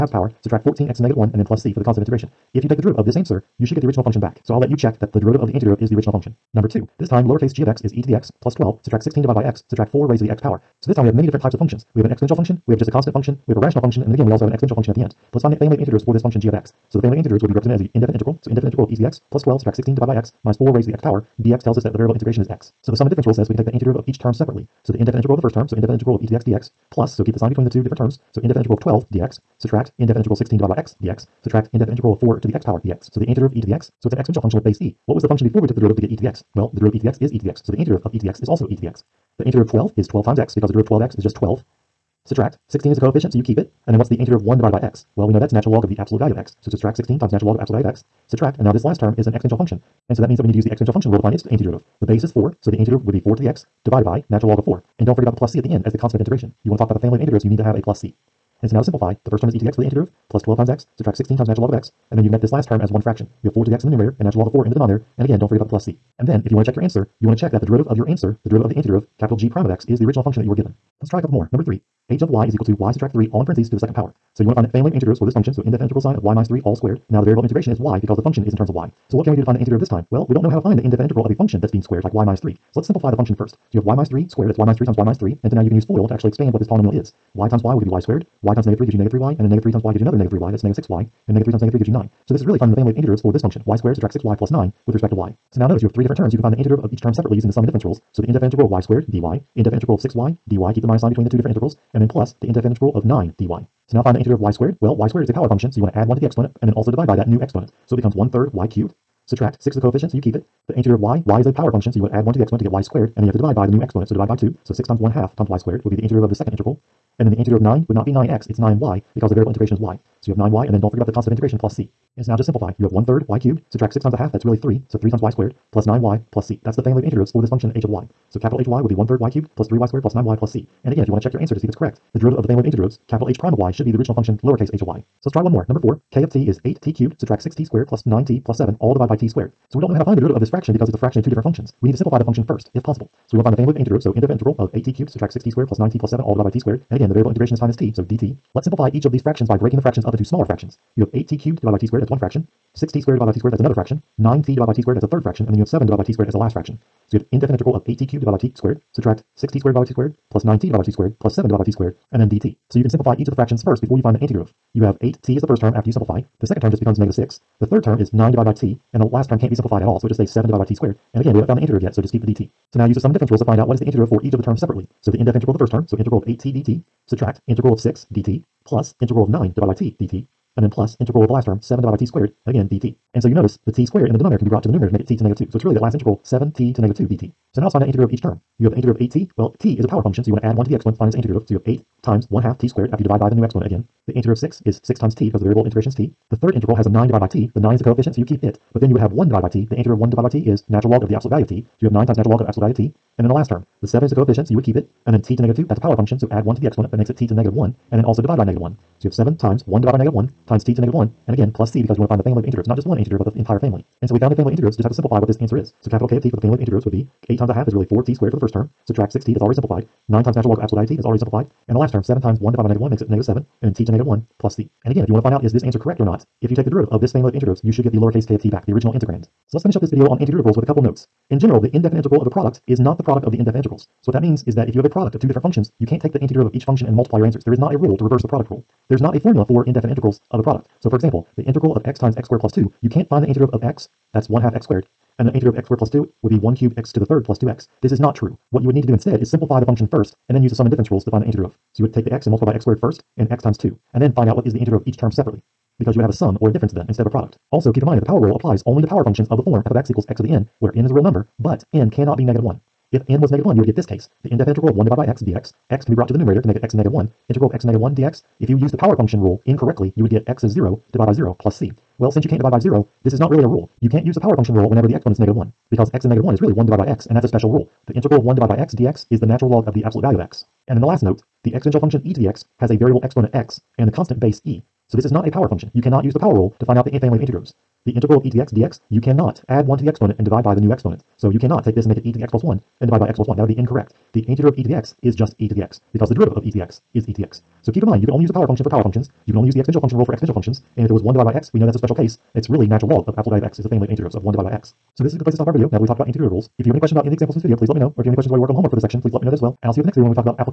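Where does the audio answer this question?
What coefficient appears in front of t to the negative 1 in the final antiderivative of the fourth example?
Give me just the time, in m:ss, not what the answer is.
3:43.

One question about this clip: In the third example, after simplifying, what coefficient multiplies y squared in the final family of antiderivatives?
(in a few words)
3.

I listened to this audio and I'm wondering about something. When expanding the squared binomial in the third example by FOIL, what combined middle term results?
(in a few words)
-6y.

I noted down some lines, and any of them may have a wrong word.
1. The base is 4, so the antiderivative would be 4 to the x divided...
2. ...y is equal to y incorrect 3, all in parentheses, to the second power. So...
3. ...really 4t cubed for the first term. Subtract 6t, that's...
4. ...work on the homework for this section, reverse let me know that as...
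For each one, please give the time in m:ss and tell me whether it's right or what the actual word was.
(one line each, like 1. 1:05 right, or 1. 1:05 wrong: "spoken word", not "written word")
1. 0:52 right
2. 1:12 wrong: "subtract", not "incorrect"
3. 3:37 wrong: "squared", not "cubed"
4. 5:08 wrong: "please", not "reverse".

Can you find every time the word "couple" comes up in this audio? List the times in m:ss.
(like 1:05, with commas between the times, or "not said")
1:11, 3:50.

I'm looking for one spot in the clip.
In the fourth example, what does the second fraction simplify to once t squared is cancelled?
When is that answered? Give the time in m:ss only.
2:46.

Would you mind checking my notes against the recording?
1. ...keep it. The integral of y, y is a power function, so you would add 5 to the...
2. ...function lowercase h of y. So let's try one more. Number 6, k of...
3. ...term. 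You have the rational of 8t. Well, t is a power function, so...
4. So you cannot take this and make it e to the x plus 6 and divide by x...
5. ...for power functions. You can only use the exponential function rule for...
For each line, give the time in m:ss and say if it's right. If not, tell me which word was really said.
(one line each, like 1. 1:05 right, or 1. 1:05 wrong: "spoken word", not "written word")
1. 1:50 wrong: "1", not "5"
2. 2:14 wrong: "4", not "6"
3. 3:08 wrong: "integral", not "rational"
4. 4:51 wrong: "1", not "6"
5. 4:58 right.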